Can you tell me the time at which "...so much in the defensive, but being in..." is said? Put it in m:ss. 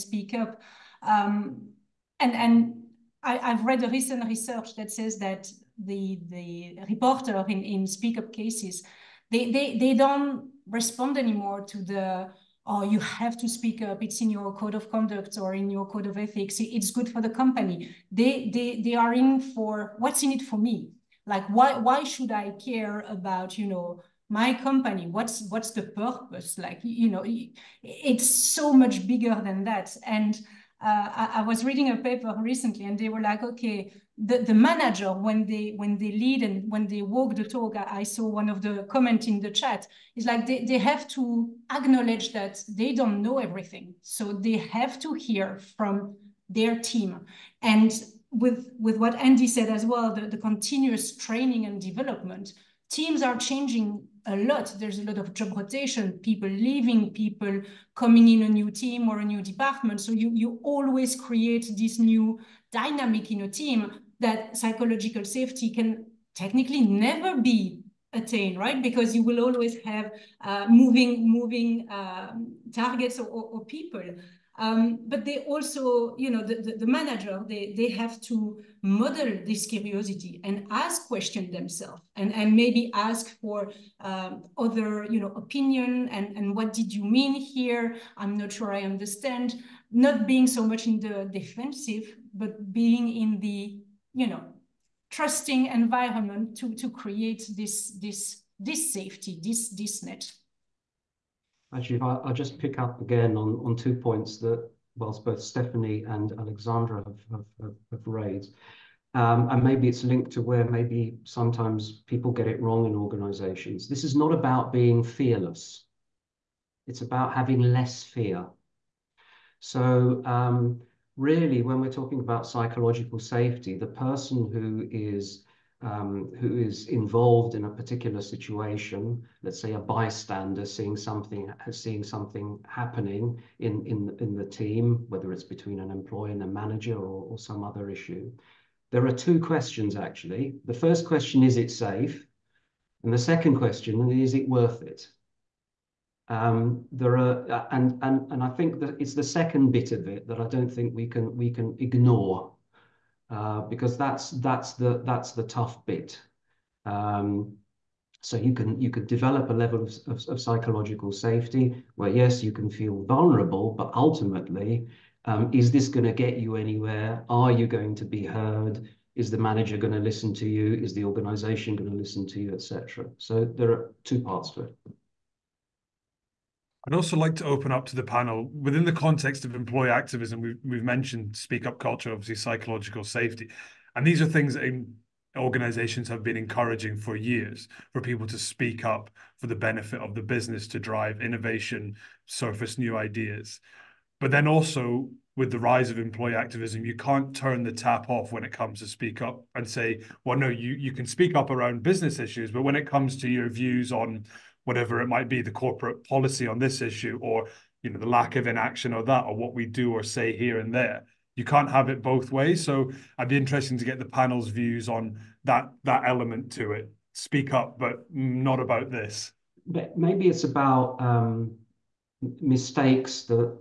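1:30.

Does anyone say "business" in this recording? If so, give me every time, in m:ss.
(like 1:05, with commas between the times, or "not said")
3:10, 3:21.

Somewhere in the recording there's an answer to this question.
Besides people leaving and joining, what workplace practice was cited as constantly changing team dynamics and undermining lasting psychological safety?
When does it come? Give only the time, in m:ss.
0:55.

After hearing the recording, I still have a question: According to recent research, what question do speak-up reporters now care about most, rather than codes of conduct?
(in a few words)
What's in it for me.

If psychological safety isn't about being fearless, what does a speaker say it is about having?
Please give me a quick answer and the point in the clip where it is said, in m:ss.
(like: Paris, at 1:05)
Less fear, at 1:57.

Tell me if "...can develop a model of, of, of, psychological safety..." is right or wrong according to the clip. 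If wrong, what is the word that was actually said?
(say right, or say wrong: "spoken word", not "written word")
wrong: "level", not "model".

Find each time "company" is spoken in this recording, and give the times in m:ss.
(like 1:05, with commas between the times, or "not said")
0:17, 0:24.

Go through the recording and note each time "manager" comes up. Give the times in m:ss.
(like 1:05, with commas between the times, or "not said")
0:34, 1:16, 2:16, 2:49.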